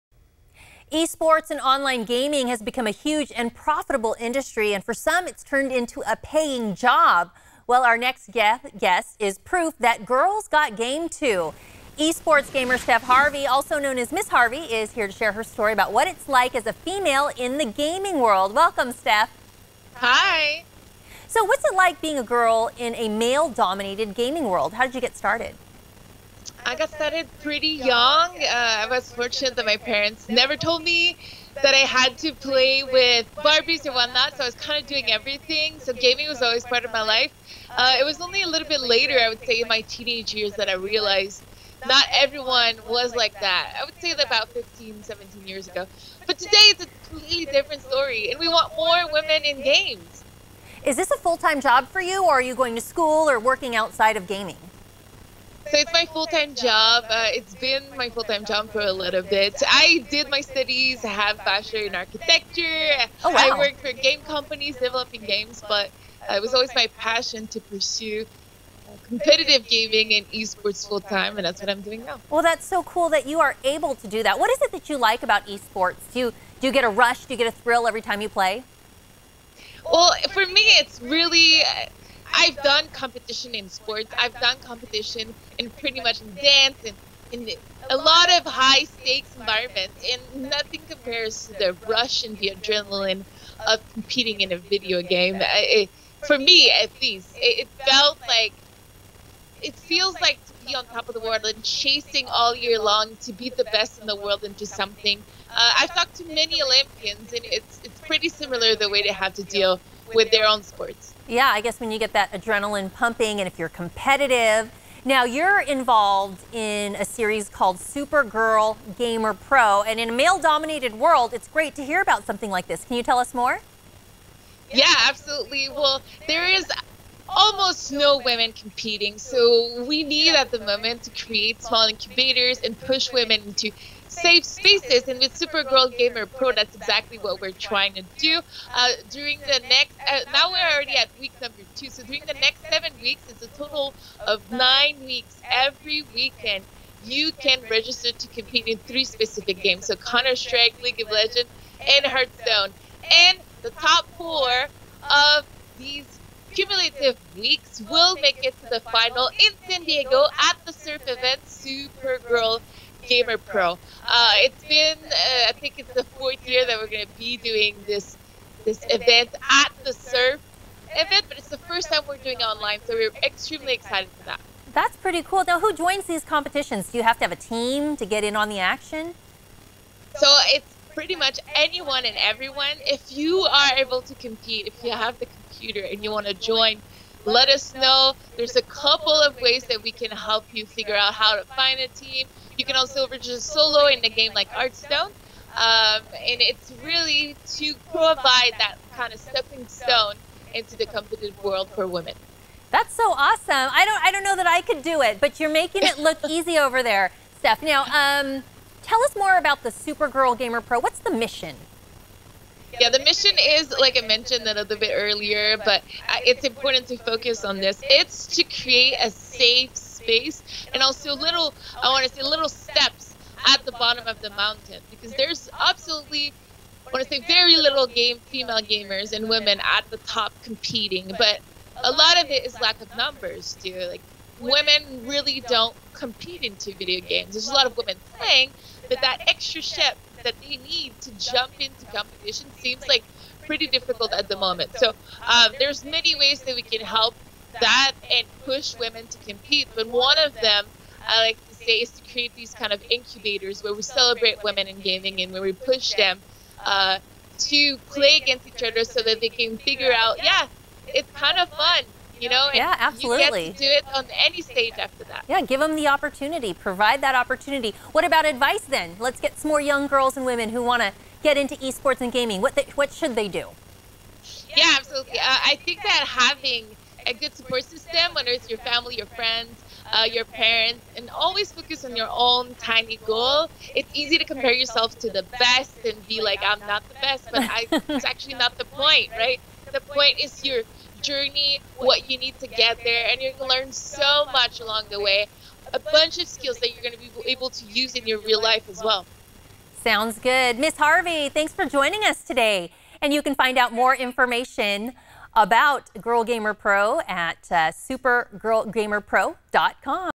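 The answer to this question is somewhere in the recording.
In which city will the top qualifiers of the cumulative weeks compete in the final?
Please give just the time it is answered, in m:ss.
2:39.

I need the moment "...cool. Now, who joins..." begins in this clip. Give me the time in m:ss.
2:55.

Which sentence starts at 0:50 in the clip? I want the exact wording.
Is this a full time job for you, or are you going to school or working outside of gaming?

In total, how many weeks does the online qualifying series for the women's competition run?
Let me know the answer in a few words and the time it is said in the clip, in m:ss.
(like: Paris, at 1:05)
9, at 2:24.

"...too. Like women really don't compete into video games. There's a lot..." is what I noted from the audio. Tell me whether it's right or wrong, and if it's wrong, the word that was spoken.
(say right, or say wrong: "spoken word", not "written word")
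right.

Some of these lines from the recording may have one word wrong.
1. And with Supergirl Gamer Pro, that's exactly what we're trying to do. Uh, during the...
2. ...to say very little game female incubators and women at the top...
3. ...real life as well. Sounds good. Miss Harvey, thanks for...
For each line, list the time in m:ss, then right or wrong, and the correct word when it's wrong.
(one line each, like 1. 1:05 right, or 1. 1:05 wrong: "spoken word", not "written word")
1. 2:15 right
2. 3:47 wrong: "gamers", not "incubators"
3. 4:58 right.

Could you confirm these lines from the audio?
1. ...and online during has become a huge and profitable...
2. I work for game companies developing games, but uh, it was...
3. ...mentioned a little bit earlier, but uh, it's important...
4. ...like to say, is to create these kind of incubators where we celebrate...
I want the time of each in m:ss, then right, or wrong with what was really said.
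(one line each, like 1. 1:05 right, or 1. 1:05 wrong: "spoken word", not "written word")
1. 0:01 wrong: "gaming", not "during"
2. 1:03 right
3. 3:34 right
4. 4:11 right.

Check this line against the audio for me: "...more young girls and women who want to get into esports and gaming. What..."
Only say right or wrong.
right.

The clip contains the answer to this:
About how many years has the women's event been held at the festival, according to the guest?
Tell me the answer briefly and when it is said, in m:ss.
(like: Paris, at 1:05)
4th year, at 2:46.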